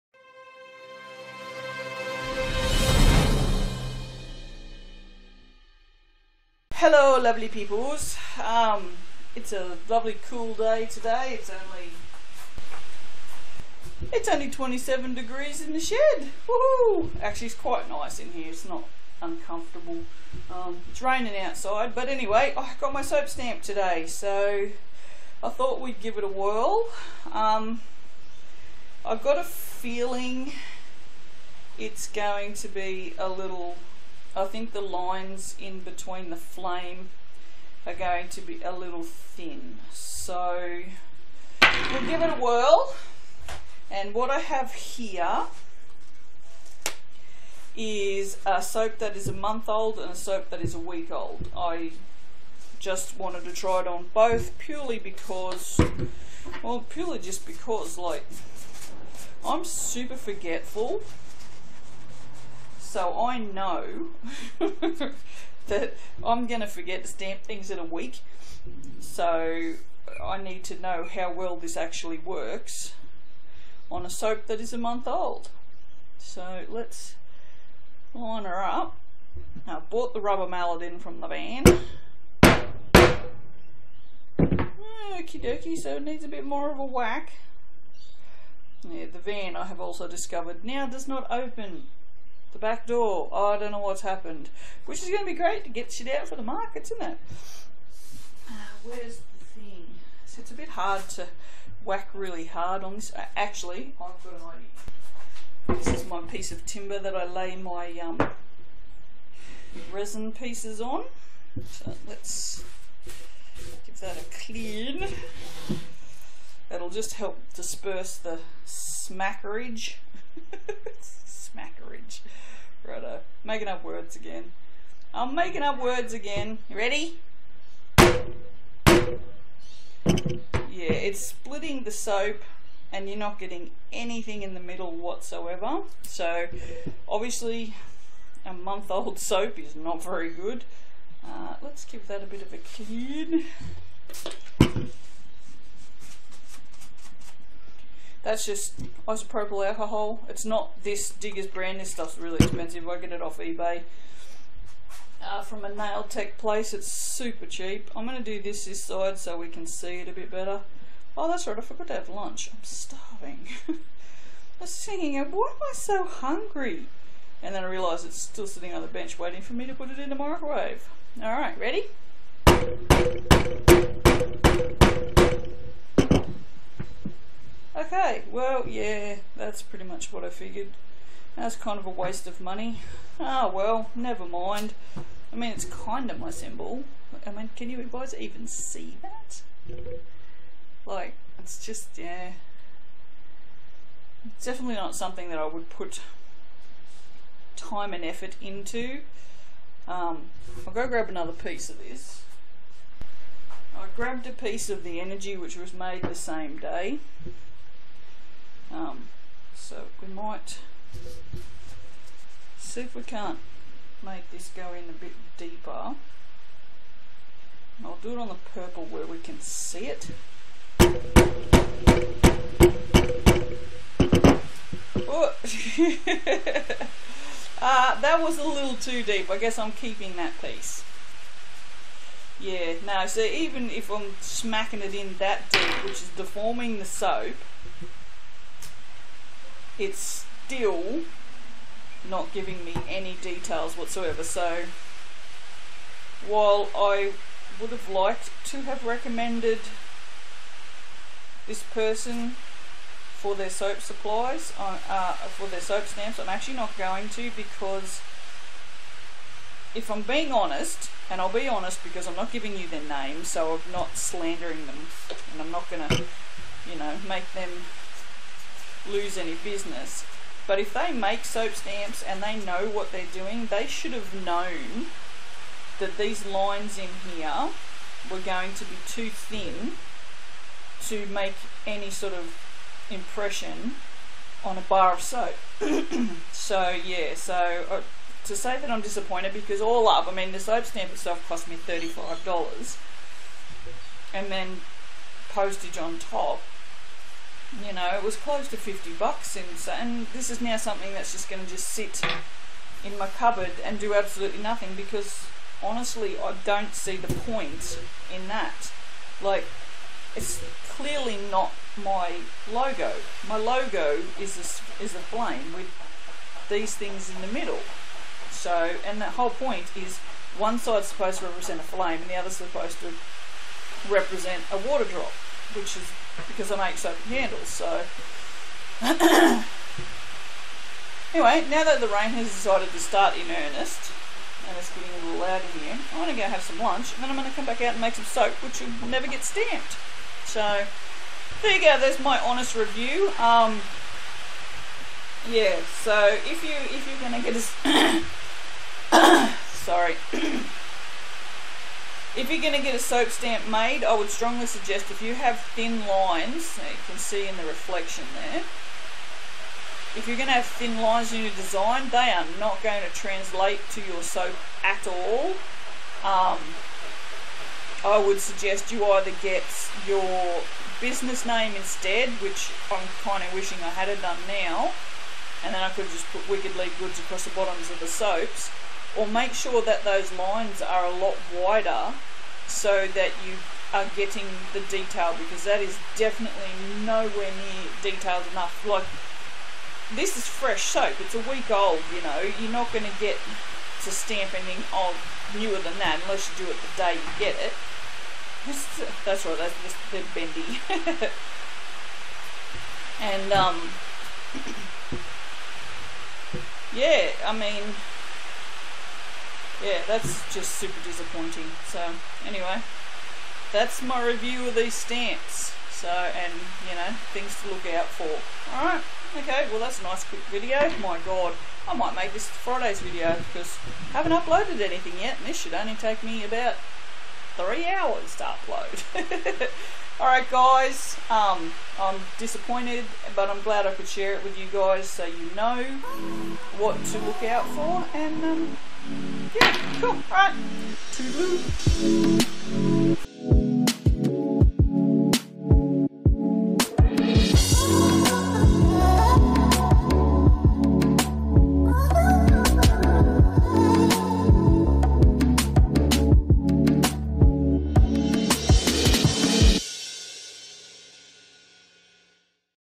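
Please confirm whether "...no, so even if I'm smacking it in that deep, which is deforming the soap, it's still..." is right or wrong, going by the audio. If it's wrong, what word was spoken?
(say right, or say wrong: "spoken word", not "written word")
right.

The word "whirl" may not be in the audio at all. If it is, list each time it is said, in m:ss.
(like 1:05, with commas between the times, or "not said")
0:26, 0:42.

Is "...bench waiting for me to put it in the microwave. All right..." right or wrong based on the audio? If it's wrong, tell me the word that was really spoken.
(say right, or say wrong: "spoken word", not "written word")
right.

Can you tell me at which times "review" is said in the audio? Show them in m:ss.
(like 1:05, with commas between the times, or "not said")
5:42, 6:54.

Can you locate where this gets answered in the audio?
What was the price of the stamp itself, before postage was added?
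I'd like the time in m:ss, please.
4:51.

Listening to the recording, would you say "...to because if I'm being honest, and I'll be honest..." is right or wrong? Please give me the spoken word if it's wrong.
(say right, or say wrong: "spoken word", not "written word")
right.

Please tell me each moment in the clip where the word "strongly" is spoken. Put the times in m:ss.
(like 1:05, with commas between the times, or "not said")
5:54.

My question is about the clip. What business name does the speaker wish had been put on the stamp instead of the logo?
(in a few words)
Wicked Lee Goods.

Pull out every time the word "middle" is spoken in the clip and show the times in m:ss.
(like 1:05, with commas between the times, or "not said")
2:14, 5:17.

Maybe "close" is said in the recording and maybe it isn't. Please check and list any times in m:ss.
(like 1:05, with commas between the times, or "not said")
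4:58.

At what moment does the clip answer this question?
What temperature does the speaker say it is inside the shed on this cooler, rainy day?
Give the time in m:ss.
0:14.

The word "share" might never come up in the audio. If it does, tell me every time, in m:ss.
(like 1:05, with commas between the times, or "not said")
7:13.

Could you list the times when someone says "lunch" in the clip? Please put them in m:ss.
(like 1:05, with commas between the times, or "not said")
2:42, 5:36.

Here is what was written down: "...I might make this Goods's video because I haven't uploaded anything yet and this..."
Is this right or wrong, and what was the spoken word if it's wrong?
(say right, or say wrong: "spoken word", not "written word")
wrong: "Friday", not "Goods".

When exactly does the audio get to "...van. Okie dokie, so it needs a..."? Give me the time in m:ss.
1:21.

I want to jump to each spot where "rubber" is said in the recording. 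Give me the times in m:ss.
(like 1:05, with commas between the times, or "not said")
1:20.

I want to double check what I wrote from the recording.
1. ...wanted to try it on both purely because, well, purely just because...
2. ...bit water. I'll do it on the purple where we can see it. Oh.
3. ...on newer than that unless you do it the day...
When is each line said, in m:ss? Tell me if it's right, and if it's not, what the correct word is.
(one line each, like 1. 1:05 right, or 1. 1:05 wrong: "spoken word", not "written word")
1. 0:53 right
2. 3:34 wrong: "deeper", not "water"
3. 6:34 right.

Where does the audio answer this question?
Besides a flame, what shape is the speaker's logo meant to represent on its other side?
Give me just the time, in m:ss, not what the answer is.
5:24.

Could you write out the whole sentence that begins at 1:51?
So let's give that a clean.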